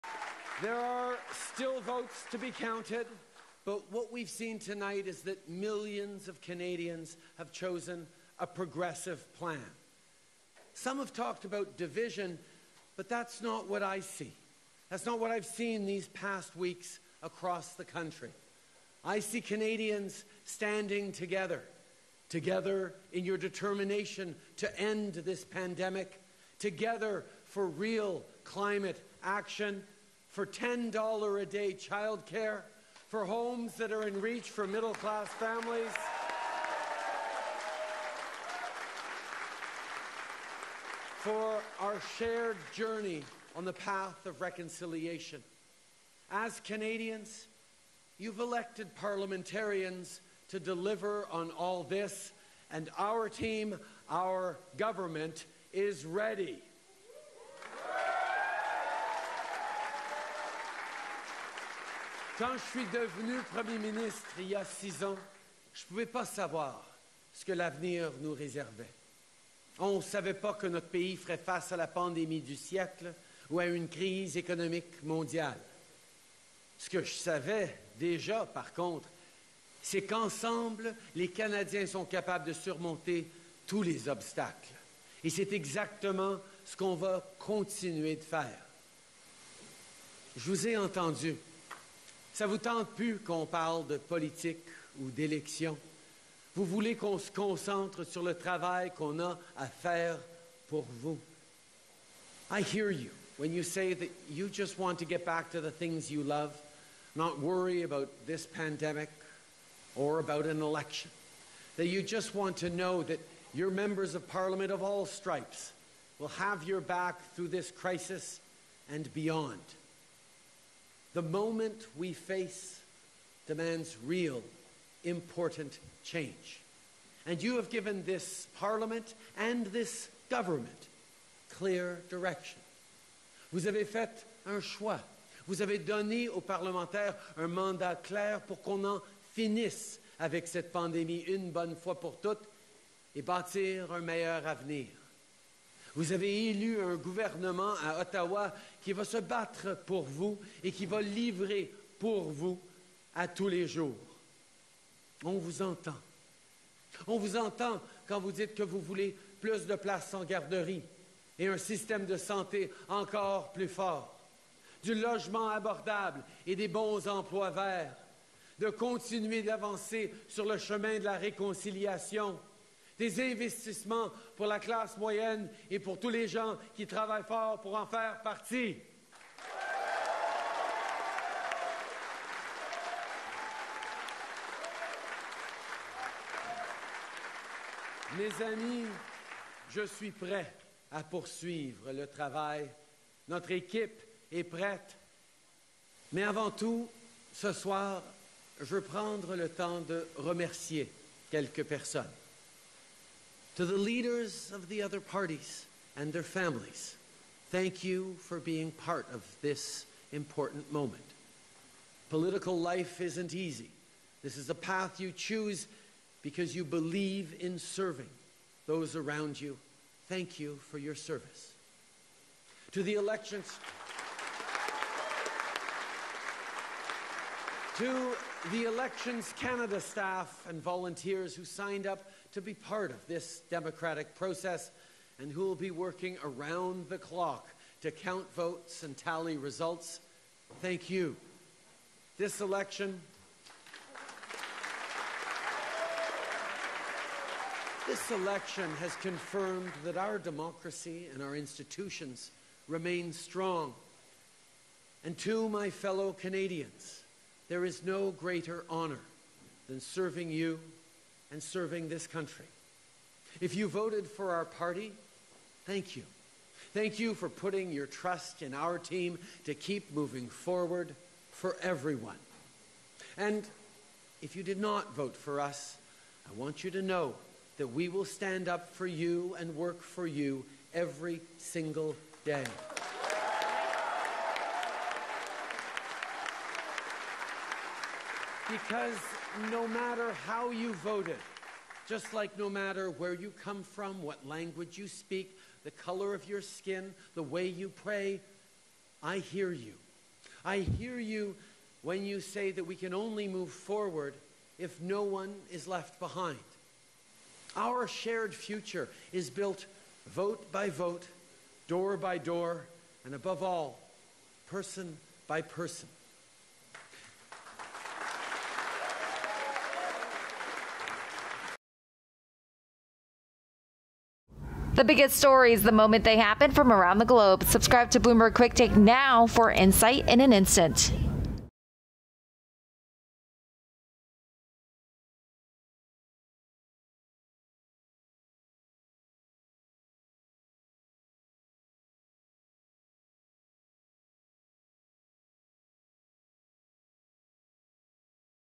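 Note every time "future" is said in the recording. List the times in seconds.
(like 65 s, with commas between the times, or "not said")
308 s.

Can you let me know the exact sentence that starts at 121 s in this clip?
The moment we face demands real, important change.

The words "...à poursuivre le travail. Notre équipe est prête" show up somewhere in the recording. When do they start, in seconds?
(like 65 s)
190 s.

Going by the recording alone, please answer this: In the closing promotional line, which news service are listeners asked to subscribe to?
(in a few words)
Bloomberg Quicktake.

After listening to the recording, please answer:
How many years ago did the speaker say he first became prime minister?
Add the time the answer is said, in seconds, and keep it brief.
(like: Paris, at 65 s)
6, at 64 s.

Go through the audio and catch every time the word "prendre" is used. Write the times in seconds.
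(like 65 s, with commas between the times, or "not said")
198 s.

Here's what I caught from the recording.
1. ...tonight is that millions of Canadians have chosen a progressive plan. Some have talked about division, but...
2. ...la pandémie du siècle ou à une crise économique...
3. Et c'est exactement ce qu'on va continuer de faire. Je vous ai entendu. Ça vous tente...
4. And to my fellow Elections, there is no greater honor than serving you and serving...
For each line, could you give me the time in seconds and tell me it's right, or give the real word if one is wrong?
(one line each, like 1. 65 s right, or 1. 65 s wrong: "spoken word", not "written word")
1. 4 s right
2. 71 s right
3. 85 s right
4. 255 s wrong: "Canadians", not "Elections".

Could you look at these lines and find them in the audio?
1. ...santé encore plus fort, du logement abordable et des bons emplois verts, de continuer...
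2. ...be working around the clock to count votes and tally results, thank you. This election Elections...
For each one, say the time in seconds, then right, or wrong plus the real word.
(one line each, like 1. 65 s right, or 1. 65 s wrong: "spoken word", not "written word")
1. 162 s right
2. 235 s wrong: "This", not "Elections".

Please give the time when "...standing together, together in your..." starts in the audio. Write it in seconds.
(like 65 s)
20 s.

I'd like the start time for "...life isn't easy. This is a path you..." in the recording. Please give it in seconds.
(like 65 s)
212 s.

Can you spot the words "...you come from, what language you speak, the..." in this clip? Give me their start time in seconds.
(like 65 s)
293 s.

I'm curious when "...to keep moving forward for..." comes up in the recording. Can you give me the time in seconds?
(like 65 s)
269 s.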